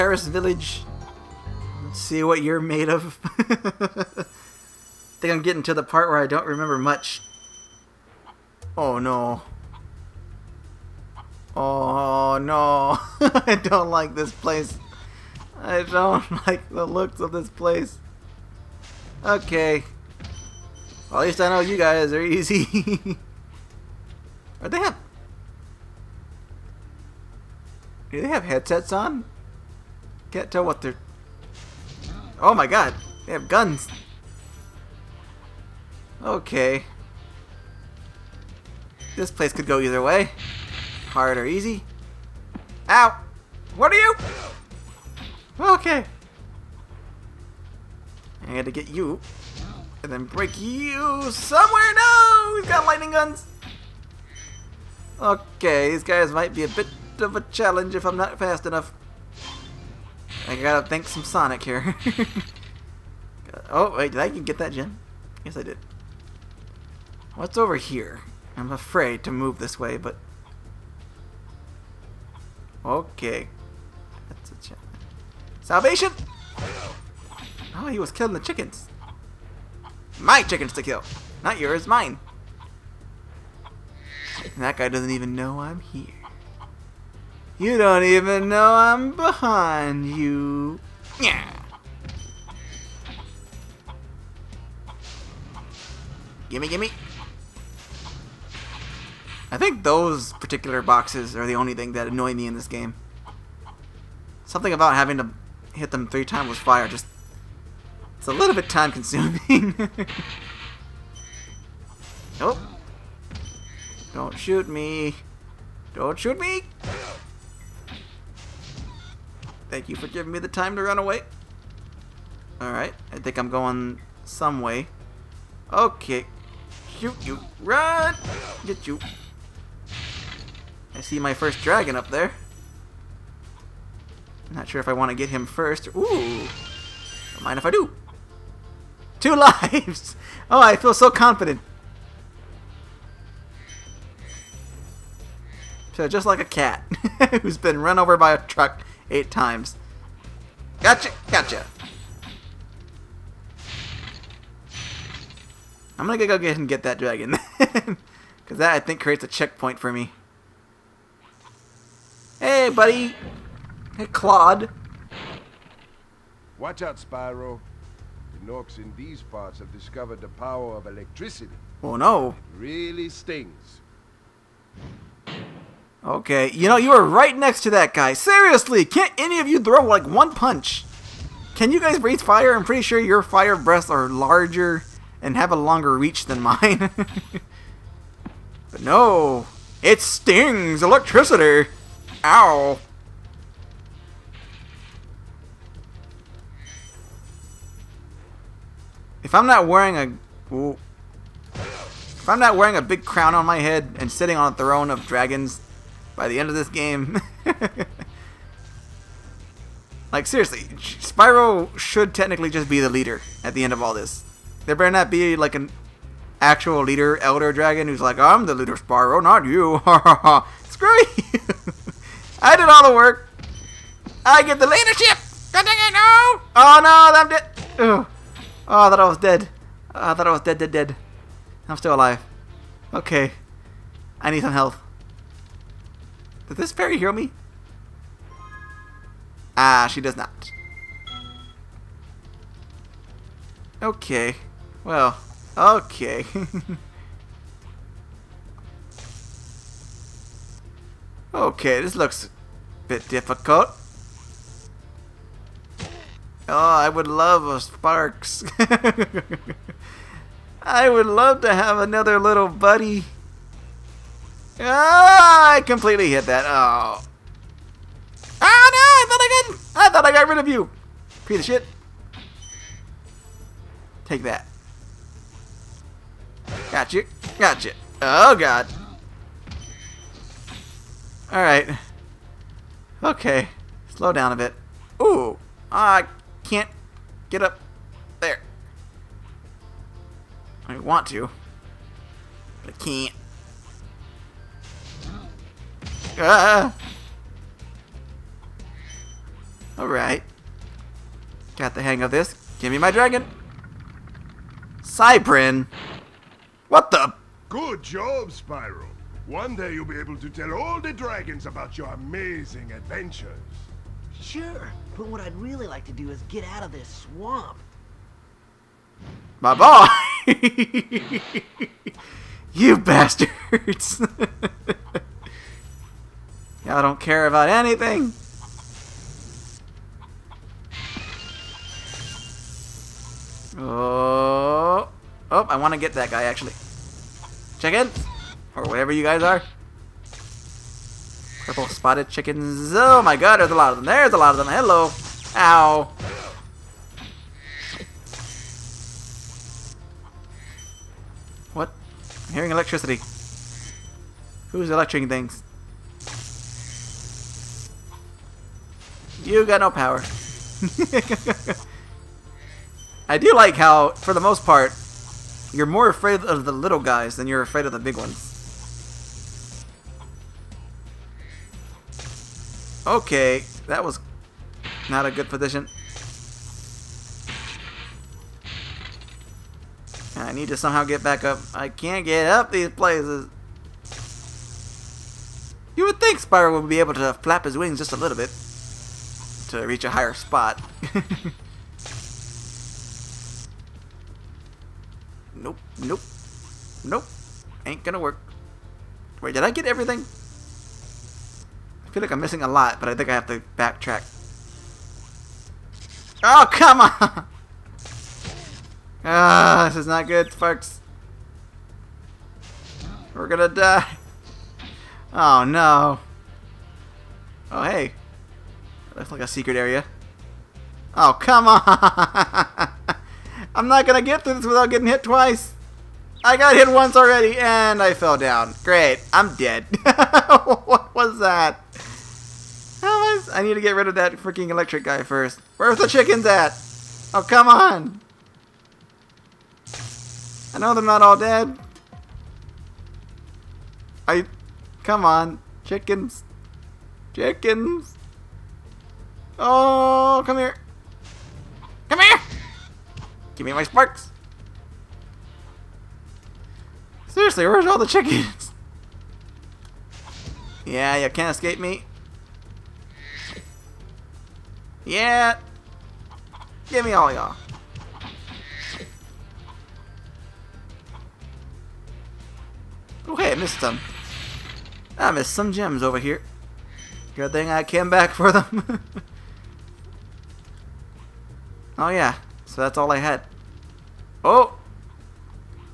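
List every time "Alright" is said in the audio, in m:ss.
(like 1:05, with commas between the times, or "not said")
2:02, 4:59.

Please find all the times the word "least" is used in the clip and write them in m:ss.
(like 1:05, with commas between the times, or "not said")
0:21.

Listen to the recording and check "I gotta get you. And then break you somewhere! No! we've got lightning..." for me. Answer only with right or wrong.
right.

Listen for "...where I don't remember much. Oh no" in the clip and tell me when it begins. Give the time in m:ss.
0:06.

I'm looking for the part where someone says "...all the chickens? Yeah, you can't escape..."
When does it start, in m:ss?
7:37.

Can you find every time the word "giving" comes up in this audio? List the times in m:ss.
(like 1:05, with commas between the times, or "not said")
2:00.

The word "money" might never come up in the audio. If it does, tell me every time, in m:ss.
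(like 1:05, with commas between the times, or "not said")
not said.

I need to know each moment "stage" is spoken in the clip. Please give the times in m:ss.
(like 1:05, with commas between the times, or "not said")
not said.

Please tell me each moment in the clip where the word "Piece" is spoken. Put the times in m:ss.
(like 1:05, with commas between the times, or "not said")
4:31.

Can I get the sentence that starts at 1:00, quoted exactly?
I gotta thank some Sonic here.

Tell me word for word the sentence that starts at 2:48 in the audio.
The Gnorcs in these parts have discovered the power of electricity.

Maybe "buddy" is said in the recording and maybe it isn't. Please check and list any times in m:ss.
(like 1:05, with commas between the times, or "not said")
2:42, 4:22.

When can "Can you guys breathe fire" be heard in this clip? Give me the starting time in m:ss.
3:01.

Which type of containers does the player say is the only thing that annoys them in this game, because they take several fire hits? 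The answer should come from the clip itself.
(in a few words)
boxes.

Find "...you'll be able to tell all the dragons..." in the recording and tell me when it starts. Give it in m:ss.
5:09.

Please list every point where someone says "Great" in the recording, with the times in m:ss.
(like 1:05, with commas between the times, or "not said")
7:08.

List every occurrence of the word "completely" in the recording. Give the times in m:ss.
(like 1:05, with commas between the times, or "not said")
4:25.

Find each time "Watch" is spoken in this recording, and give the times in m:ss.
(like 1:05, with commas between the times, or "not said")
2:46.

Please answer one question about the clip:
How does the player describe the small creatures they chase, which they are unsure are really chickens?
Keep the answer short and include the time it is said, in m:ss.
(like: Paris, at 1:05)
purple spotted chickens, at 5:41.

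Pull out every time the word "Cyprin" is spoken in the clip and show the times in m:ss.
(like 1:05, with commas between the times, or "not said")
5:04.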